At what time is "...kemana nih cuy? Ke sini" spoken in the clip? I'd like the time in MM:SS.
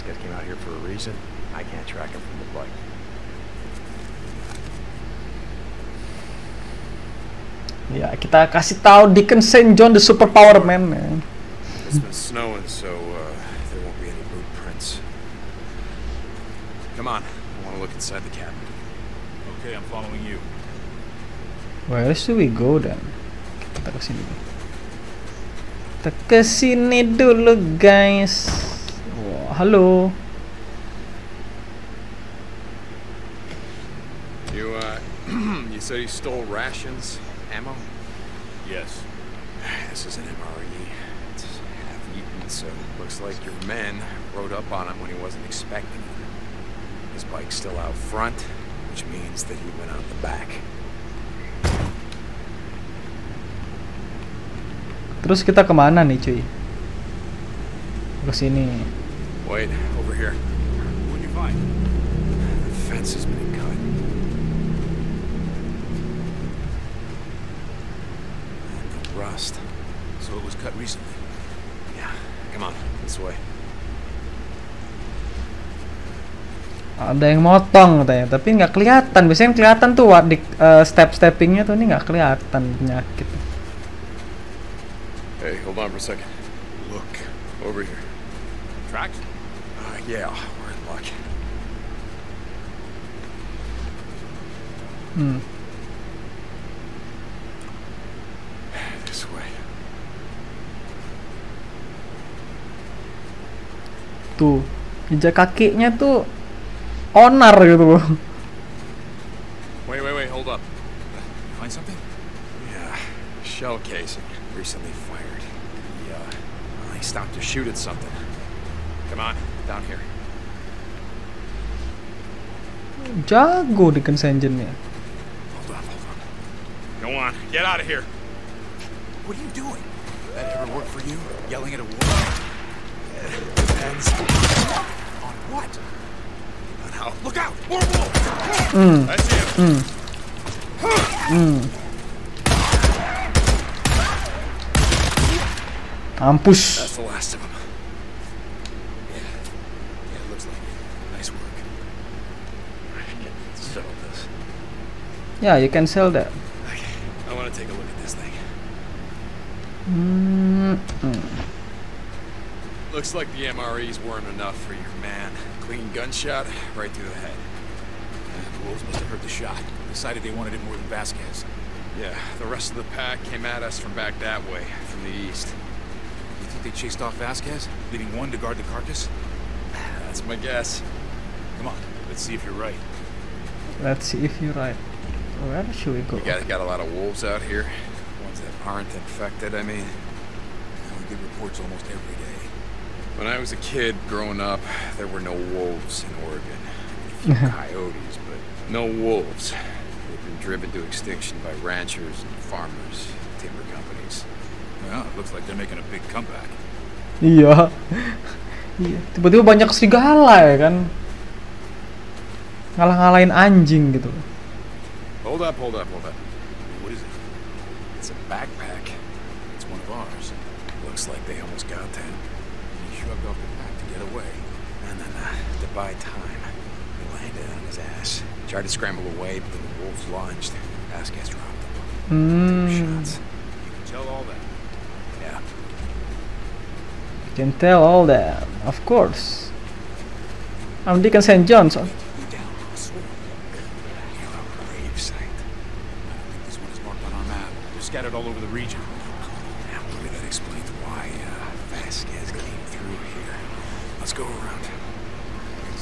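00:55.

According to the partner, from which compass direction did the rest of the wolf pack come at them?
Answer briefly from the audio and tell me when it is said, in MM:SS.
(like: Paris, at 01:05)
East, at 02:54.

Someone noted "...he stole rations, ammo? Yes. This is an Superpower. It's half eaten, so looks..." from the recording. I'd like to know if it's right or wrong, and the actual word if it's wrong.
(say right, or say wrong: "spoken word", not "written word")
wrong: "MRE", not "Superpower".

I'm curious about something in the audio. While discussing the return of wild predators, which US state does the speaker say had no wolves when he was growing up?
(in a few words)
Oregon.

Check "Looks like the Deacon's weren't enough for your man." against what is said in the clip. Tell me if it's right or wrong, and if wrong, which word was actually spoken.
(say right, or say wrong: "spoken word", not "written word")
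wrong: "MRE", not "Deacon".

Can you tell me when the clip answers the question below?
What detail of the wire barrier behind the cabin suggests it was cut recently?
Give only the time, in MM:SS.
01:08.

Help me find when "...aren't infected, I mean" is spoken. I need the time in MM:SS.
03:08.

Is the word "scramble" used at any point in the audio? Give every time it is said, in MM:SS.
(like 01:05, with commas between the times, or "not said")
03:48.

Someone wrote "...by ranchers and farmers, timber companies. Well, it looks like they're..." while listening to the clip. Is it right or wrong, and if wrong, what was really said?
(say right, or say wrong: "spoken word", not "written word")
right.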